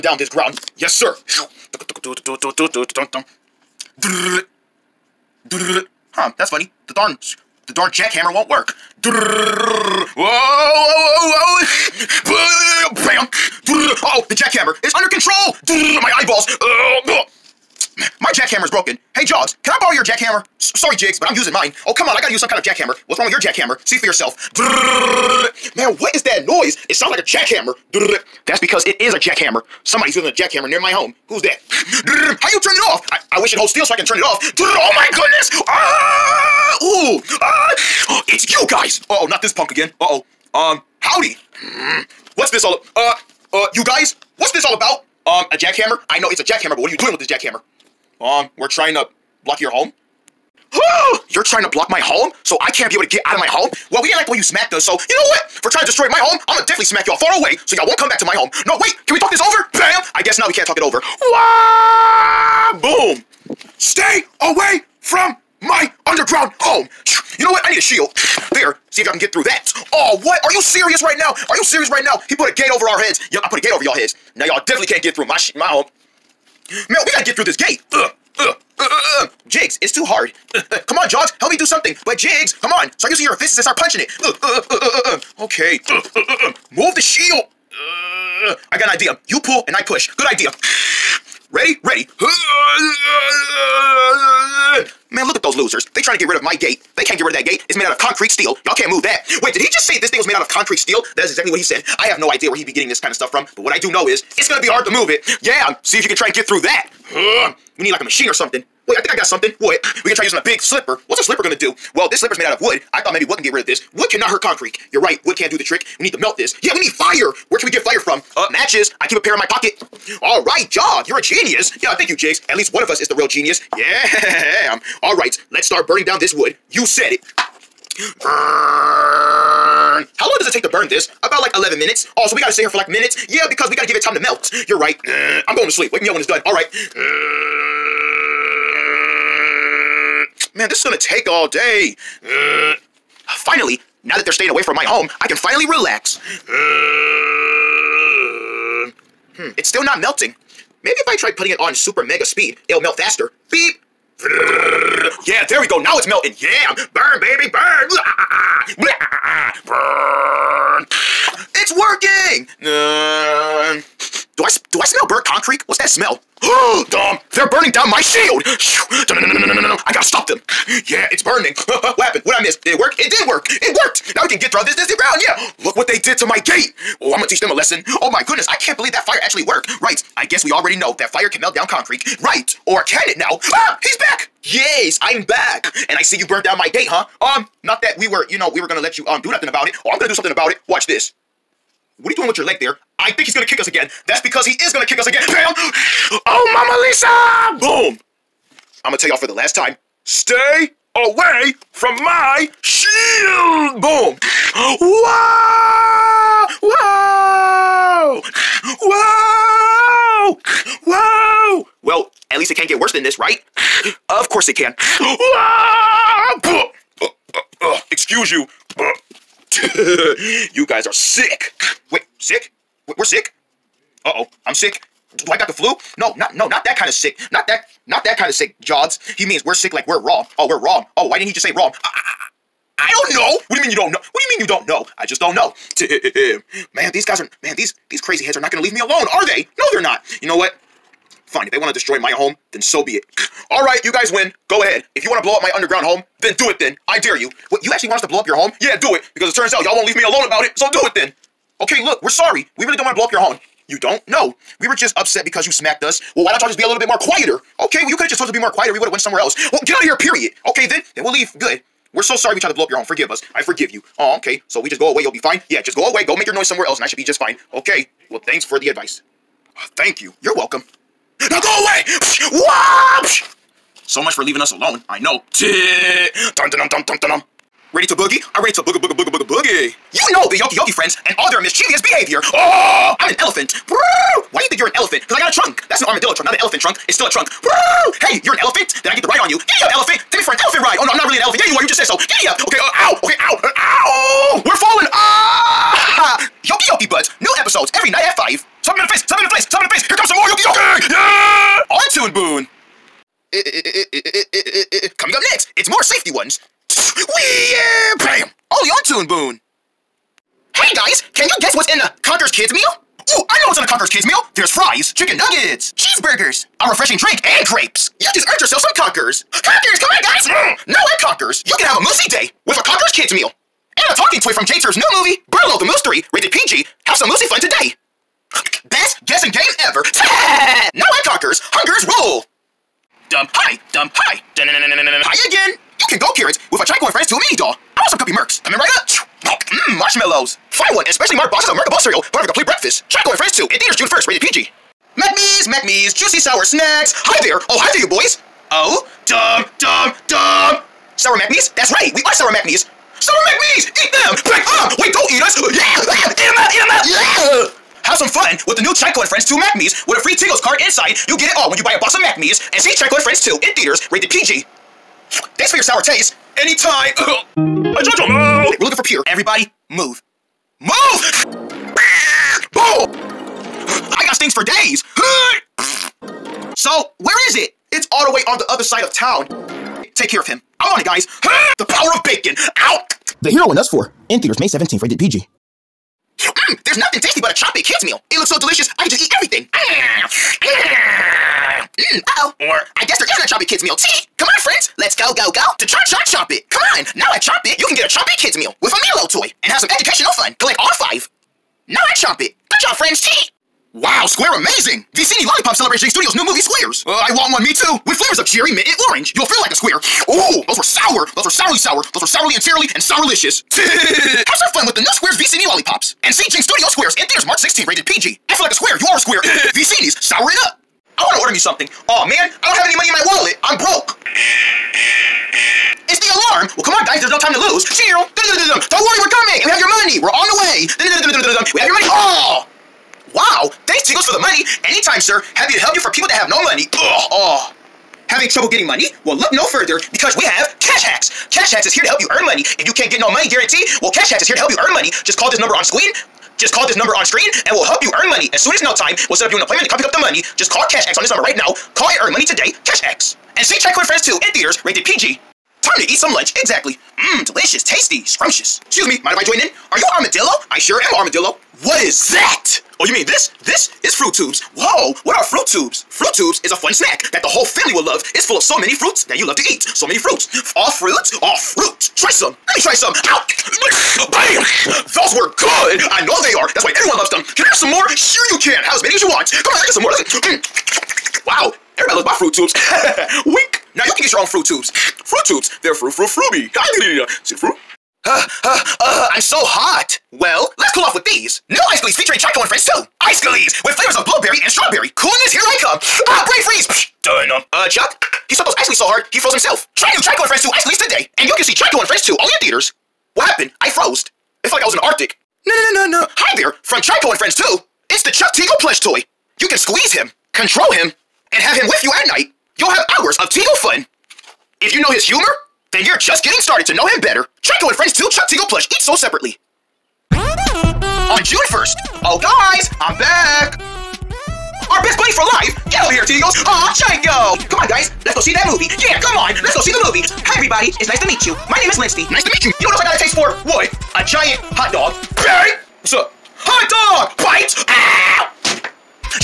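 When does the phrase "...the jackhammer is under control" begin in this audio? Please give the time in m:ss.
0:14.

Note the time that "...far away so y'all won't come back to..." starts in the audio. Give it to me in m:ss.
0:57.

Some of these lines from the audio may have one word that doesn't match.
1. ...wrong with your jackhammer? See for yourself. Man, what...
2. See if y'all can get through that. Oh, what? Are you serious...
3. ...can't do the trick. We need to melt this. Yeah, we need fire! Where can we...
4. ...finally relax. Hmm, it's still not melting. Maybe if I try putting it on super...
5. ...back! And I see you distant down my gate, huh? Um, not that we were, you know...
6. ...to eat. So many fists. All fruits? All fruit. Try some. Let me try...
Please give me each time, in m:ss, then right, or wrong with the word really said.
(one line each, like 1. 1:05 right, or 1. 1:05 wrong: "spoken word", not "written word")
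1. 0:23 right
2. 1:08 right
3. 1:55 right
4. 2:25 right
5. 3:05 wrong: "burnt", not "distant"
6. 7:49 wrong: "fruits", not "fists".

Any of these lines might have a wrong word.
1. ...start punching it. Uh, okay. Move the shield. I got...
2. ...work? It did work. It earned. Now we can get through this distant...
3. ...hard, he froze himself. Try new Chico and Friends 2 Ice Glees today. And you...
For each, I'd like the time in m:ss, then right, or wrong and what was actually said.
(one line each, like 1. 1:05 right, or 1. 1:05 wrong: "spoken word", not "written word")
1. 1:23 right
2. 2:52 wrong: "worked", not "earned"
3. 8:18 right.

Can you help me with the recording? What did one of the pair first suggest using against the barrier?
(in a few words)
a big slipper.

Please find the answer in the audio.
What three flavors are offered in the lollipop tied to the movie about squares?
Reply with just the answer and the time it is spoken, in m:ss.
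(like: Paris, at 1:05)
cherry, mint, and orange, at 6:48.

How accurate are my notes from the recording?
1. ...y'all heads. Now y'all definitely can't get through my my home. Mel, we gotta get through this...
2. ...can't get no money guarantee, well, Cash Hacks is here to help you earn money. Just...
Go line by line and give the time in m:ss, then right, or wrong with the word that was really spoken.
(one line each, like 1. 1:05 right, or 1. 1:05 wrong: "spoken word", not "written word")
1. 1:13 right
2. 7:22 right.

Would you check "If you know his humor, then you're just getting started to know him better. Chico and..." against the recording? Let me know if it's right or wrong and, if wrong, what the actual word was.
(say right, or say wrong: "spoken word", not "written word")
right.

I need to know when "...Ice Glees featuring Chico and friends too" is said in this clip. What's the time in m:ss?
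8:11.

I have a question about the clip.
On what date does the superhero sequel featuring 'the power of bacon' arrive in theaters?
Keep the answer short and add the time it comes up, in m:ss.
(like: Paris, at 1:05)
May 17th, at 6:24.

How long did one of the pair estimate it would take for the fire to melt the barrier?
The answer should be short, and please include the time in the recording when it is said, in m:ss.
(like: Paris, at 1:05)
11 minutes, at 2:11.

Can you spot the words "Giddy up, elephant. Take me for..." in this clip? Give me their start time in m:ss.
4:49.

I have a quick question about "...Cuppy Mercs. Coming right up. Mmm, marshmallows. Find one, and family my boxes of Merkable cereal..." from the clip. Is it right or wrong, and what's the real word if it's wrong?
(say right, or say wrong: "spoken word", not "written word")
wrong: "especially", not "family".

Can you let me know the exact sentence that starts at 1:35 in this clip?
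They trying to get rid of my gate.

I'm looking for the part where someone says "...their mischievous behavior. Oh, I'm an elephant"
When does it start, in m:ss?
4:41.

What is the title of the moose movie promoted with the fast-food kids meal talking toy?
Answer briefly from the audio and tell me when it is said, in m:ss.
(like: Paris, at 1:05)
Burlo the Moose 3, at 5:25.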